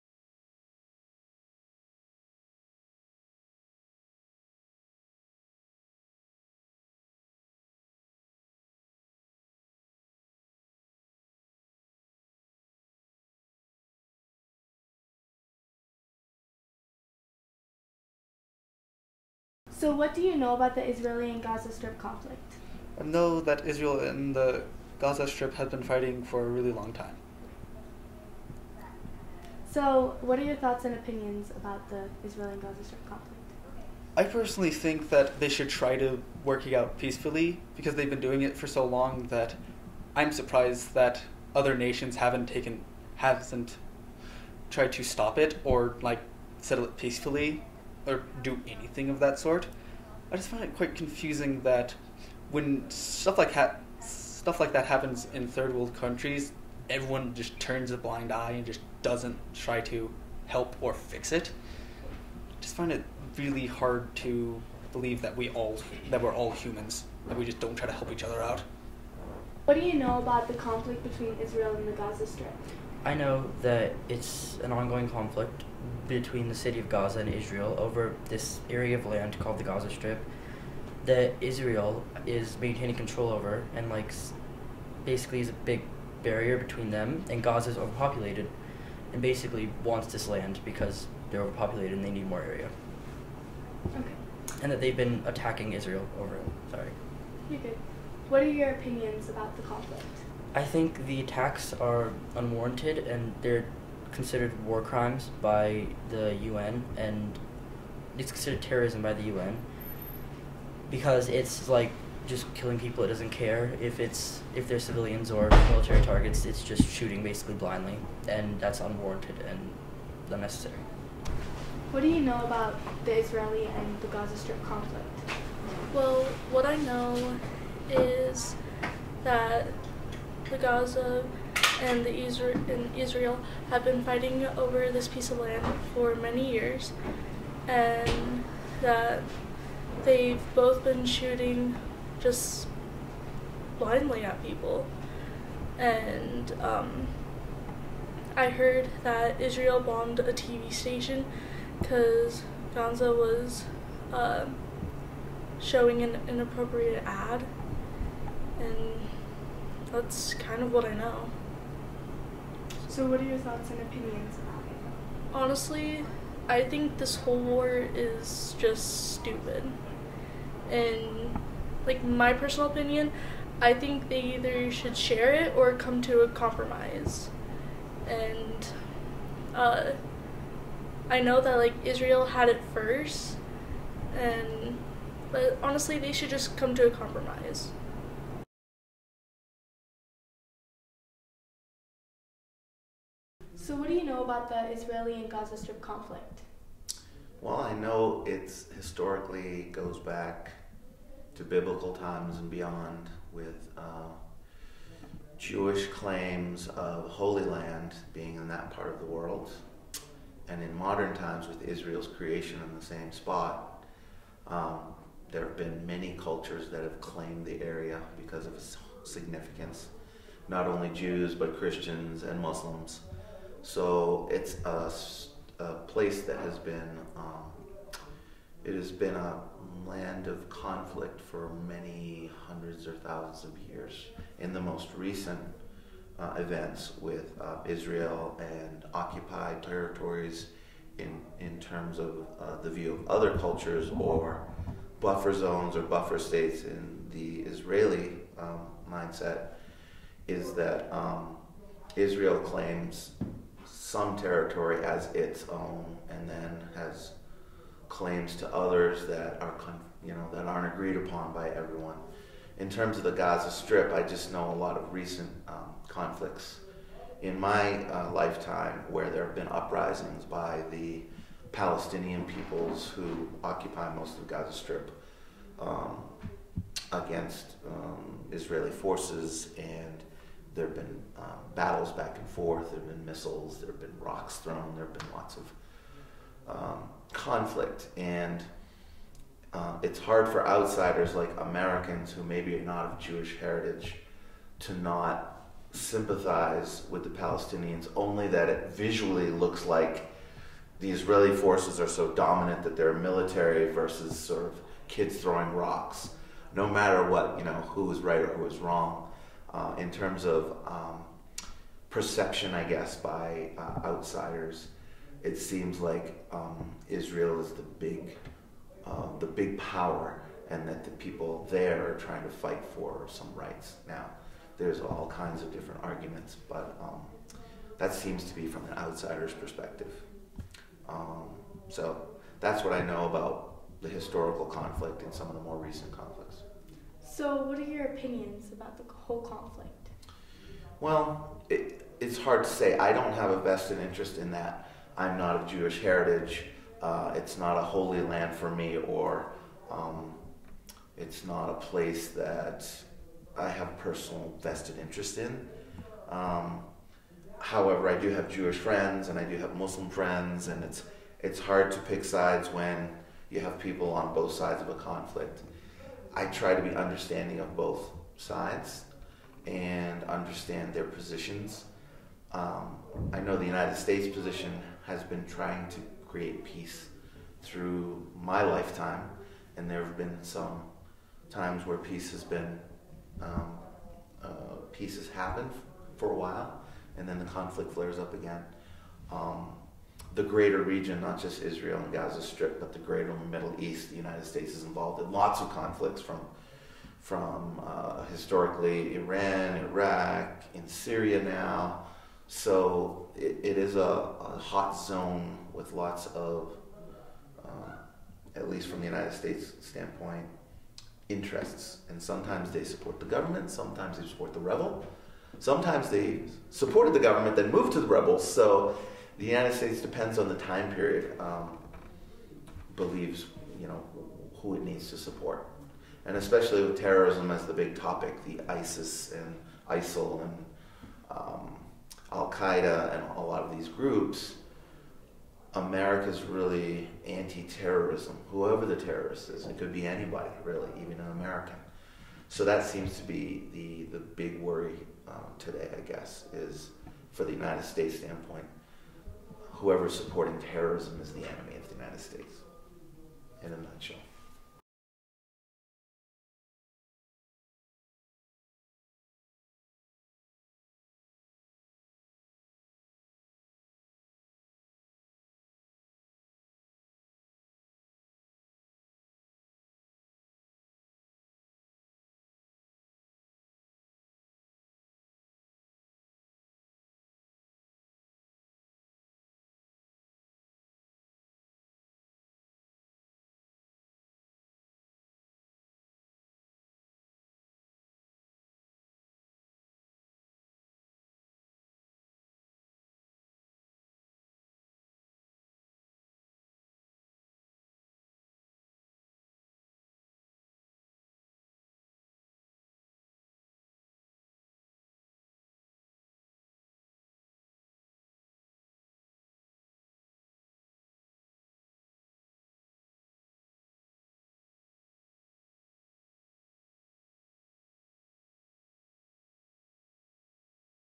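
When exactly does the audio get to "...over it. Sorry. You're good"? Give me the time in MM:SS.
01:36.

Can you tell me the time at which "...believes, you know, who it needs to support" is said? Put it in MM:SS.
07:02.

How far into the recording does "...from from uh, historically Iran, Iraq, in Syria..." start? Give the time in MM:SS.
06:36.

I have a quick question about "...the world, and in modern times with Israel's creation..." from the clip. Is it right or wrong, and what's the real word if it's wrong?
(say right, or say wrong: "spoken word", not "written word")
right.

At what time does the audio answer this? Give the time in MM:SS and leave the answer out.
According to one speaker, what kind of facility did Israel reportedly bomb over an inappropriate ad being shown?
02:30.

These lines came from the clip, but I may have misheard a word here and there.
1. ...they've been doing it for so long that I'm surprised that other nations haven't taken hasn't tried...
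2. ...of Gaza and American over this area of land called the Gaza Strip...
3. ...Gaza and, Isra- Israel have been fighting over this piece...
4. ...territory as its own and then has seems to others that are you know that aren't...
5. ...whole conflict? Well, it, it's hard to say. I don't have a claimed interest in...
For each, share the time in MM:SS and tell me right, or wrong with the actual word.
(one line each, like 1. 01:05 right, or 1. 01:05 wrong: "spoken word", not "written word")
1. 00:37 right
2. 01:16 wrong: "Israel", not "American"
3. 02:10 right
4. 04:14 wrong: "claims", not "seems"
5. 05:38 wrong: "vested", not "claimed".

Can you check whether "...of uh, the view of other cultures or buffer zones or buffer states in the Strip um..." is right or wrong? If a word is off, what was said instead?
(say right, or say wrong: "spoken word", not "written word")
wrong: "Israeli", not "Strip".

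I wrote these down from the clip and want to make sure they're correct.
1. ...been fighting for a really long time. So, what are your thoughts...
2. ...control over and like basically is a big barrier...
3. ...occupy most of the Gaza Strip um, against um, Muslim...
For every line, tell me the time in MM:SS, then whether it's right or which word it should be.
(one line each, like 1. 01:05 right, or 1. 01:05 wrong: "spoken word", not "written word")
1. 00:25 right
2. 01:22 right
3. 04:33 wrong: "Israeli", not "Muslim".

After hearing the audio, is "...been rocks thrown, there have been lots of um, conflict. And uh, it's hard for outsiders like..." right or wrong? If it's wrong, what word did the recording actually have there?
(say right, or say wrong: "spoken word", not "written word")
right.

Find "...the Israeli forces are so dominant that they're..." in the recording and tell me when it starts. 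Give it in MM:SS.
05:00.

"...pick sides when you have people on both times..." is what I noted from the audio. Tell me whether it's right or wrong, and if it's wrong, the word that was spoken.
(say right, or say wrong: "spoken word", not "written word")
wrong: "sides", not "times".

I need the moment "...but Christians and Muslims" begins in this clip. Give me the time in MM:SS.
03:41.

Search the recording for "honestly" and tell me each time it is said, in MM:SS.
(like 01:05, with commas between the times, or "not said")
02:45, 03:05.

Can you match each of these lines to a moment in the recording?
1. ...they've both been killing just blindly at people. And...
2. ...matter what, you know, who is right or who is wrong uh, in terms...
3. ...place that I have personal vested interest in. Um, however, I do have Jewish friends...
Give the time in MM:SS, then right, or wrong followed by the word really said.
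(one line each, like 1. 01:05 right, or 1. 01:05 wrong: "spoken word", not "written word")
1. 02:20 wrong: "shooting", not "killing"
2. 05:06 right
3. 05:51 right.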